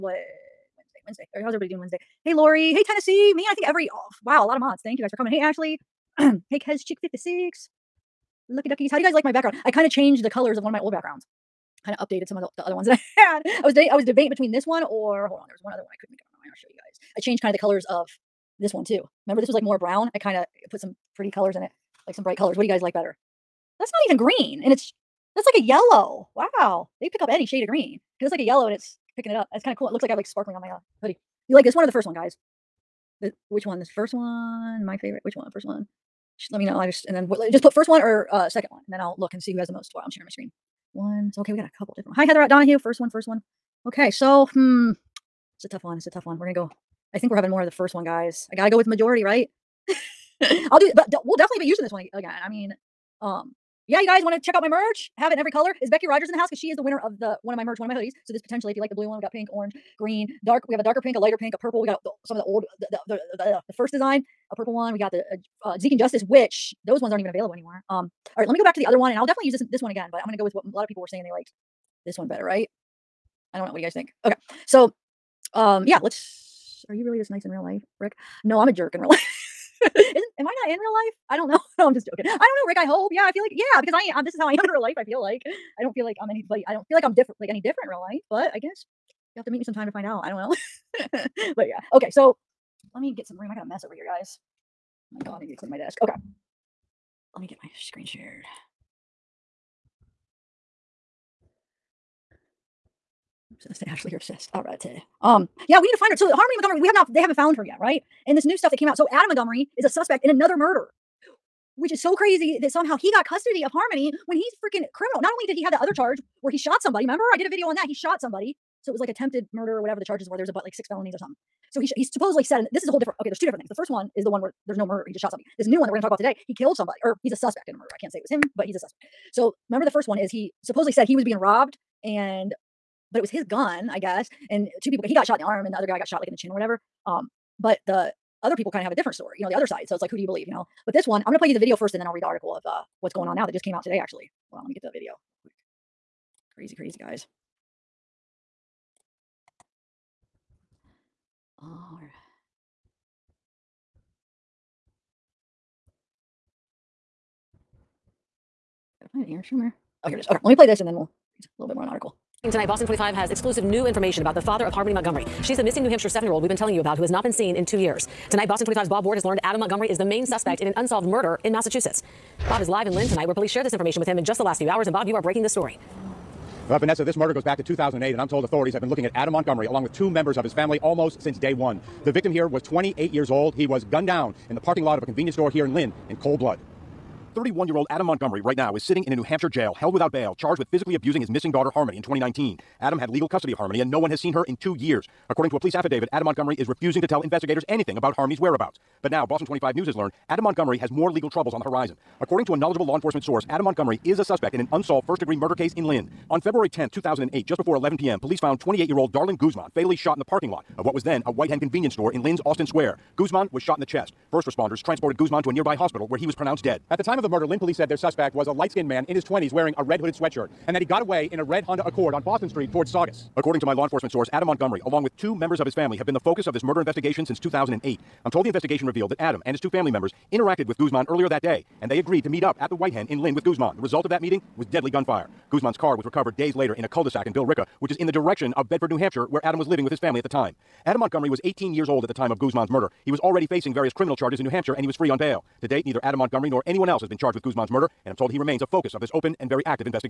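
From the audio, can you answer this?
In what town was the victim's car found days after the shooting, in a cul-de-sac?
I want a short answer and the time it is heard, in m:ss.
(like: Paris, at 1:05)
Billerica, at 3:57.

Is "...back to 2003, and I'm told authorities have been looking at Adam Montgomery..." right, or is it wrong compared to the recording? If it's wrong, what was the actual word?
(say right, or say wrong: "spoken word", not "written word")
wrong: "2008", not "2003".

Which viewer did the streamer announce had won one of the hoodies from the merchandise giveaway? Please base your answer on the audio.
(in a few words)
Becky Rogers.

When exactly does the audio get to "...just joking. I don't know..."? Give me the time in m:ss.
1:21.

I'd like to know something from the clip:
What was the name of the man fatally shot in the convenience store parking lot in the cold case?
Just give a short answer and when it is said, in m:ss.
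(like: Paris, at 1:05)
Darlin Guzman, at 3:29.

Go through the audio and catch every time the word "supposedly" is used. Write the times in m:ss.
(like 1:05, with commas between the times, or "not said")
2:02, 2:10.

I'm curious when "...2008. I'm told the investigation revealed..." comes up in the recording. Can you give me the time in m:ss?
3:47.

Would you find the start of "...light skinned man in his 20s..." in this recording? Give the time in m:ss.
3:38.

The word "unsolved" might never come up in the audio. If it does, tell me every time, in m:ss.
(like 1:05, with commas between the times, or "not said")
2:50, 3:24.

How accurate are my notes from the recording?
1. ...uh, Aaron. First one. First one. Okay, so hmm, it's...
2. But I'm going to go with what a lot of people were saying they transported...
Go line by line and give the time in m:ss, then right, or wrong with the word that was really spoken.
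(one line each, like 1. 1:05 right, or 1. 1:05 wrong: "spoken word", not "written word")
1. 0:42 wrong: "Donahue", not "Aaron"
2. 1:10 wrong: "liked", not "transported".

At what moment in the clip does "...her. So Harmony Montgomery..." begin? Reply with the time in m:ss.
1:46.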